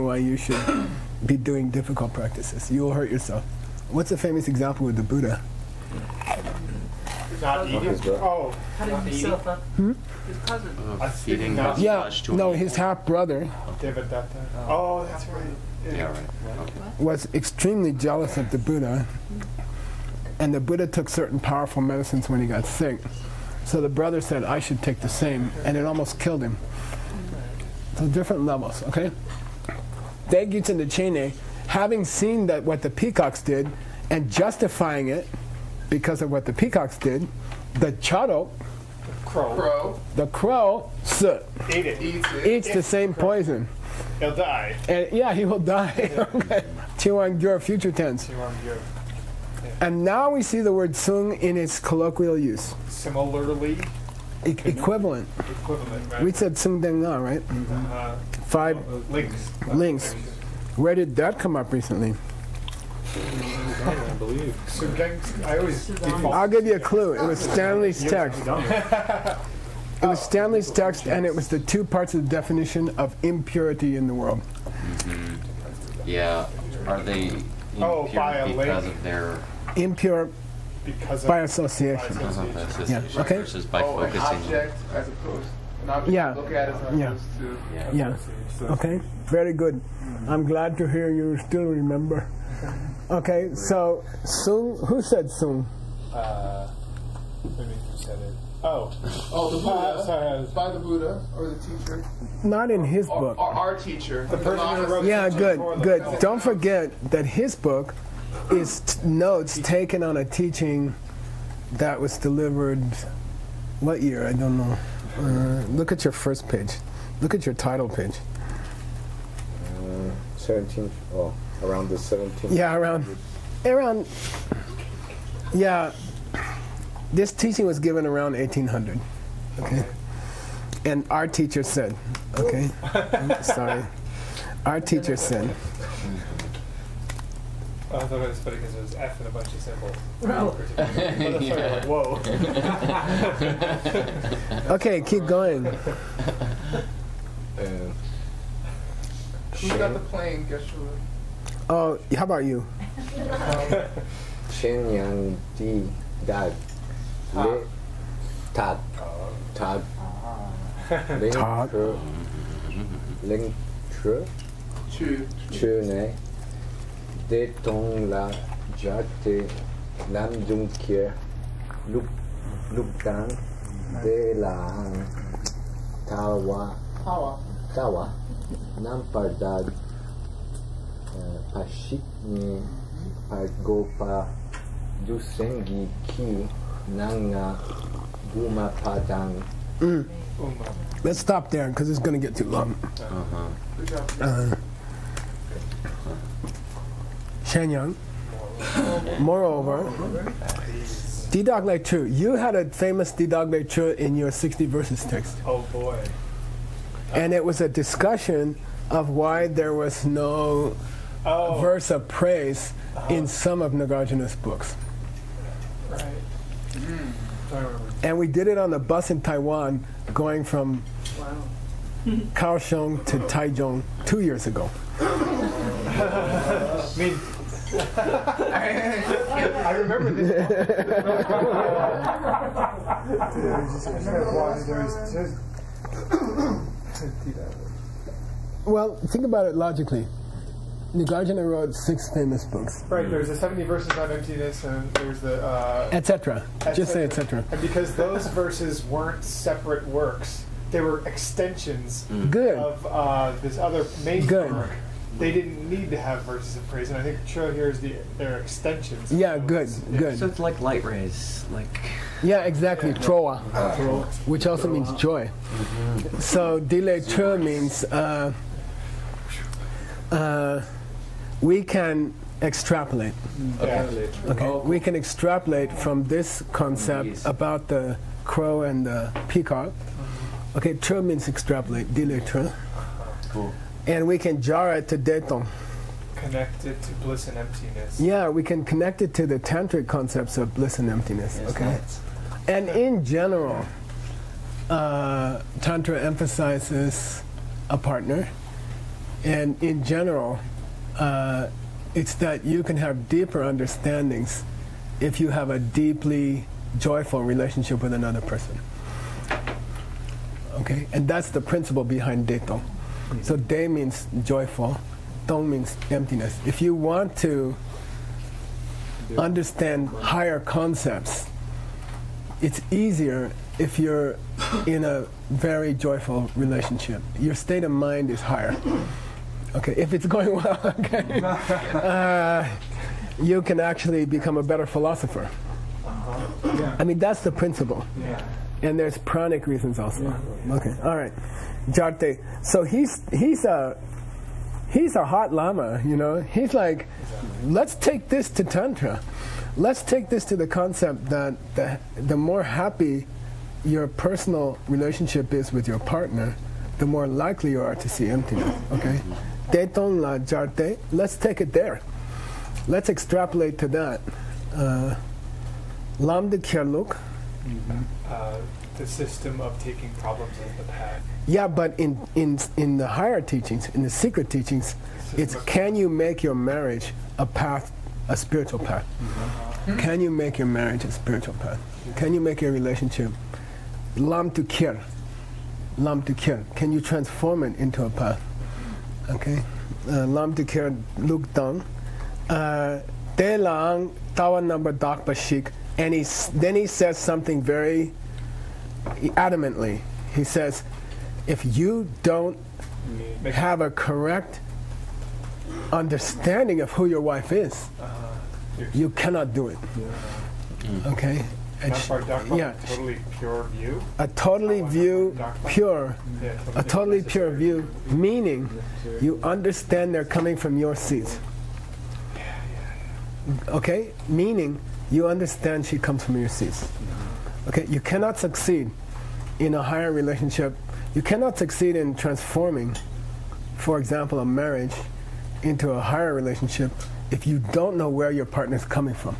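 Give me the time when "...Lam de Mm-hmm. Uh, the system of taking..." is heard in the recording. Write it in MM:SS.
06:05.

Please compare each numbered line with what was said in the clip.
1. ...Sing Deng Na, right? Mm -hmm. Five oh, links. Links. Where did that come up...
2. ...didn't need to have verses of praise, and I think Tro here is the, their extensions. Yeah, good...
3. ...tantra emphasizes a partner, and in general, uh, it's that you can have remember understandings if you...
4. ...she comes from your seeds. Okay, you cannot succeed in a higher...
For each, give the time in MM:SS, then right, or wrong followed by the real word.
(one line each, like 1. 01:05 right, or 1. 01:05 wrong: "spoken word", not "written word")
1. 00:56 right
2. 04:15 right
3. 04:55 wrong: "deeper", not "remember"
4. 07:05 right.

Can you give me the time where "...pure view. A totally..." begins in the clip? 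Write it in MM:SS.
06:53.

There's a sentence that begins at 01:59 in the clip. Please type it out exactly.
Uh, 17th, oh, around the 17th.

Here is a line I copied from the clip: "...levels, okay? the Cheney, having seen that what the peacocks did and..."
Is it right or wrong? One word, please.
right.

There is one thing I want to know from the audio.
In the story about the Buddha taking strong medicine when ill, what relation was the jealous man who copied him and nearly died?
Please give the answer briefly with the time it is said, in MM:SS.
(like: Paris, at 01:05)
Half brother, at 00:12.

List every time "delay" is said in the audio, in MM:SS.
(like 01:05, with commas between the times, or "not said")
04:26, 04:41.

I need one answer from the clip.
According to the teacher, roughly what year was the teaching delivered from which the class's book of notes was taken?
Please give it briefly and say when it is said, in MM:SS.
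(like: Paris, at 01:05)
1800, at 02:08.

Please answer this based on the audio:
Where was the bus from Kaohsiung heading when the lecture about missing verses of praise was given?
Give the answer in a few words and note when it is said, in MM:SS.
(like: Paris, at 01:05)
Taichung, at 03:43.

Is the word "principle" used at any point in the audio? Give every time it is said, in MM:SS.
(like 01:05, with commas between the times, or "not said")
05:11, 05:37.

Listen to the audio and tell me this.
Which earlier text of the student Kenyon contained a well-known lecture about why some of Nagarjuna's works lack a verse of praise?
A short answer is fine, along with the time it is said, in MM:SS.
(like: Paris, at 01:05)
60 Verses, at 03:24.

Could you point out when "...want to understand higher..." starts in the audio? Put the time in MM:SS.
05:16.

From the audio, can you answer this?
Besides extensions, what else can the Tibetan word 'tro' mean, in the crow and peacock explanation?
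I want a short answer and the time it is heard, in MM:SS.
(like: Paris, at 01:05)
Joy, at 04:24.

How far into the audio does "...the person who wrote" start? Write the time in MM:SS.
01:44.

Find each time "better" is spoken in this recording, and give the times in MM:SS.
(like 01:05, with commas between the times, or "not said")
05:34.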